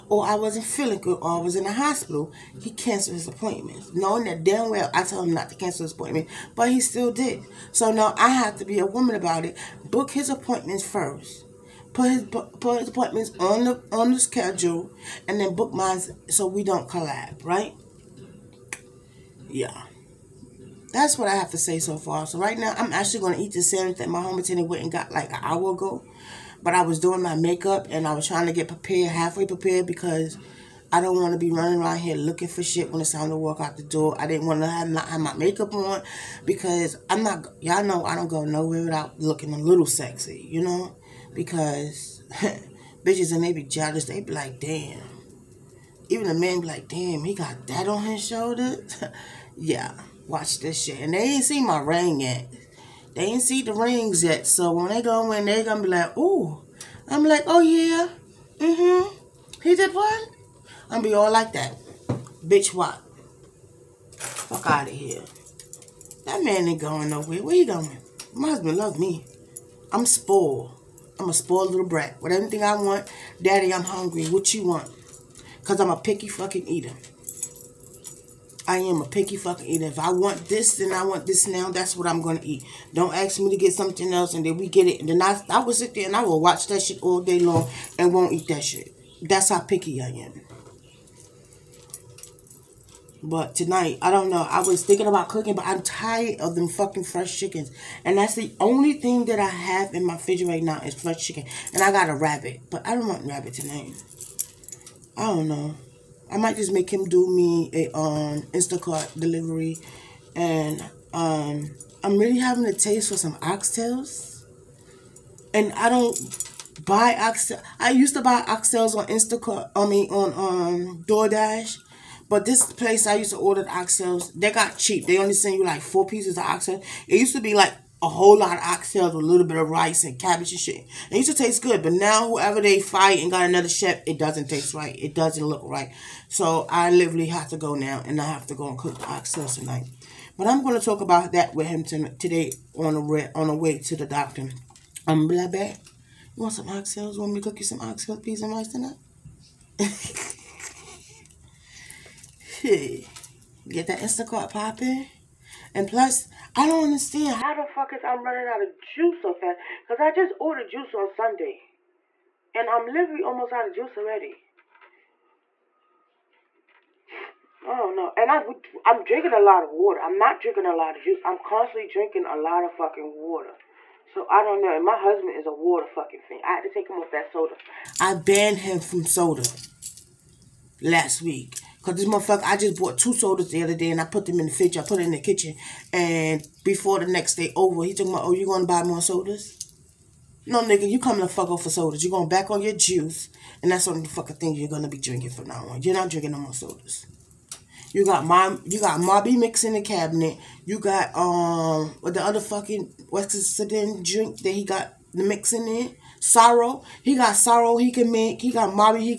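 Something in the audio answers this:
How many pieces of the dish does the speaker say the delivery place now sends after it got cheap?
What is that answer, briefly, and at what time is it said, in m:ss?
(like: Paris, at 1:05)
4, at 2:05.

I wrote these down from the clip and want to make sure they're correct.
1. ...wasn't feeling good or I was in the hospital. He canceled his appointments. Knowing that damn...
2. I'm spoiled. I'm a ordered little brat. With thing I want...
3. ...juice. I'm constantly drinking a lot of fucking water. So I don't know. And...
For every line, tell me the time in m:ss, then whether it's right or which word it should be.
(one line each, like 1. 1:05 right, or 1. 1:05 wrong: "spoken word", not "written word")
1. 0:00 right
2. 1:09 wrong: "spoiled", not "ordered"
3. 2:51 right.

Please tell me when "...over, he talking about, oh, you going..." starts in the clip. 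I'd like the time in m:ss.
3:07.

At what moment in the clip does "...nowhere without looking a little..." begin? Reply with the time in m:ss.
0:38.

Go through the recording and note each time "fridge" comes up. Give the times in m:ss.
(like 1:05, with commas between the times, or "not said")
1:40, 3:04.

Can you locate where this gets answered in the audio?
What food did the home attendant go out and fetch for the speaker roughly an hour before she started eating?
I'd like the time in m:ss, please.
0:23.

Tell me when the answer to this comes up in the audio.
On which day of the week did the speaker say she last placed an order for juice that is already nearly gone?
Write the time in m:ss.
2:41.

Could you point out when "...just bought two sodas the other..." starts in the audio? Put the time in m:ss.
3:02.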